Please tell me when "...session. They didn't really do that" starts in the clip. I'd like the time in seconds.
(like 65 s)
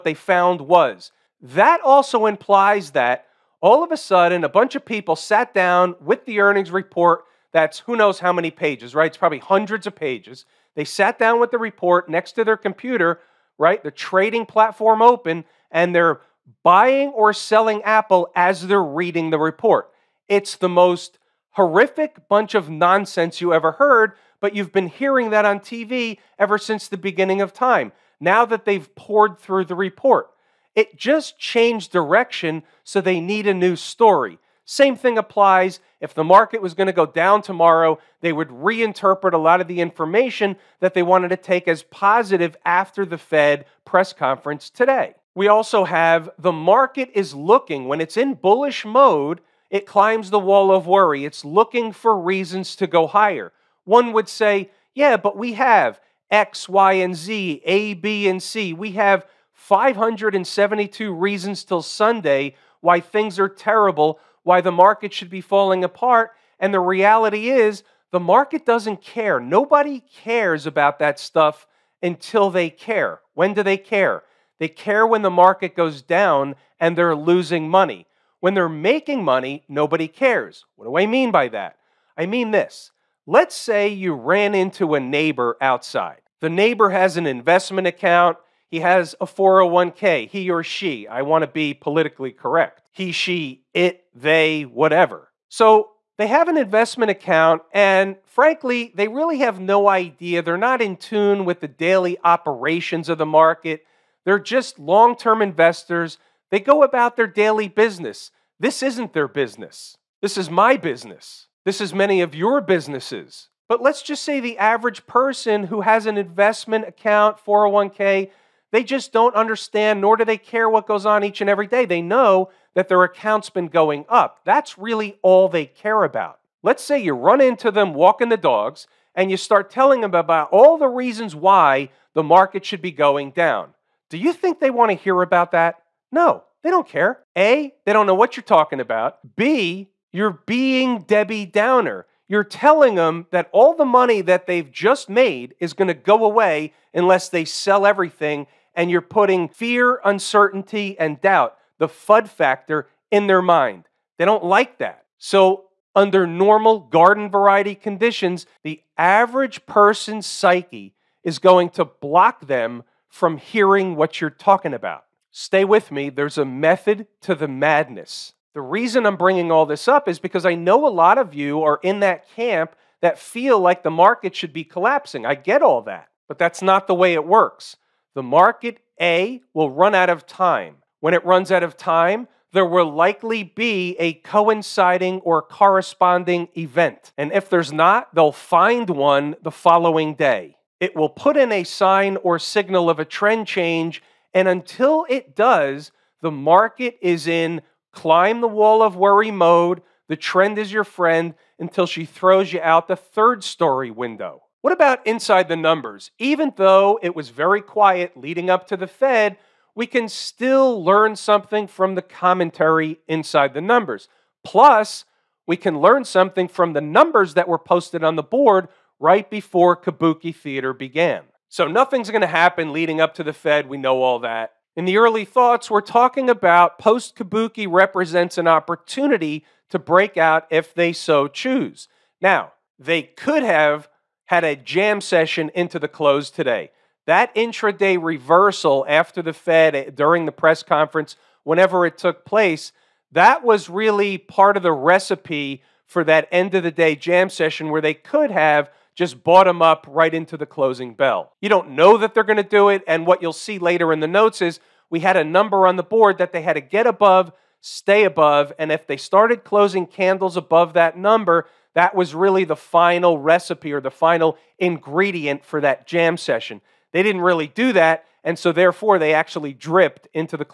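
266 s.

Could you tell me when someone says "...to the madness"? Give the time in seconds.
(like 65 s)
167 s.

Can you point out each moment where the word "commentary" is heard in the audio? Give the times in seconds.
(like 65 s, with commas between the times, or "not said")
212 s.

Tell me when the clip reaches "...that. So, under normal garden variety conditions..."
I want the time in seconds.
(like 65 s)
154 s.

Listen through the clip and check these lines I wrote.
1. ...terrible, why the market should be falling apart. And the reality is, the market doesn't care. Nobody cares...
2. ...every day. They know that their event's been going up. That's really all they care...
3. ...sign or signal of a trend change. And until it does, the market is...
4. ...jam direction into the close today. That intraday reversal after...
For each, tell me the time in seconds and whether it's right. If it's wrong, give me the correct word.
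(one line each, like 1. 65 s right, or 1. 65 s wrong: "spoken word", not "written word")
1. 63 s right
2. 121 s wrong: "account", not "event"
3. 191 s right
4. 234 s wrong: "session", not "direction".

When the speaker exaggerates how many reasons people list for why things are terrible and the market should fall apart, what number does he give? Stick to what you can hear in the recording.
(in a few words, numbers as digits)
572.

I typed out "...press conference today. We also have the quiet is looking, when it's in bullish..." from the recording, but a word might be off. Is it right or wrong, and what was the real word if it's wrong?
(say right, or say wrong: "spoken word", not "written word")
wrong: "market", not "quiet".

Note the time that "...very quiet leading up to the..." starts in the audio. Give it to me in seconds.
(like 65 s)
207 s.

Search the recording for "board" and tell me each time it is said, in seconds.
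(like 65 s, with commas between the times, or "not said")
218 s, 255 s.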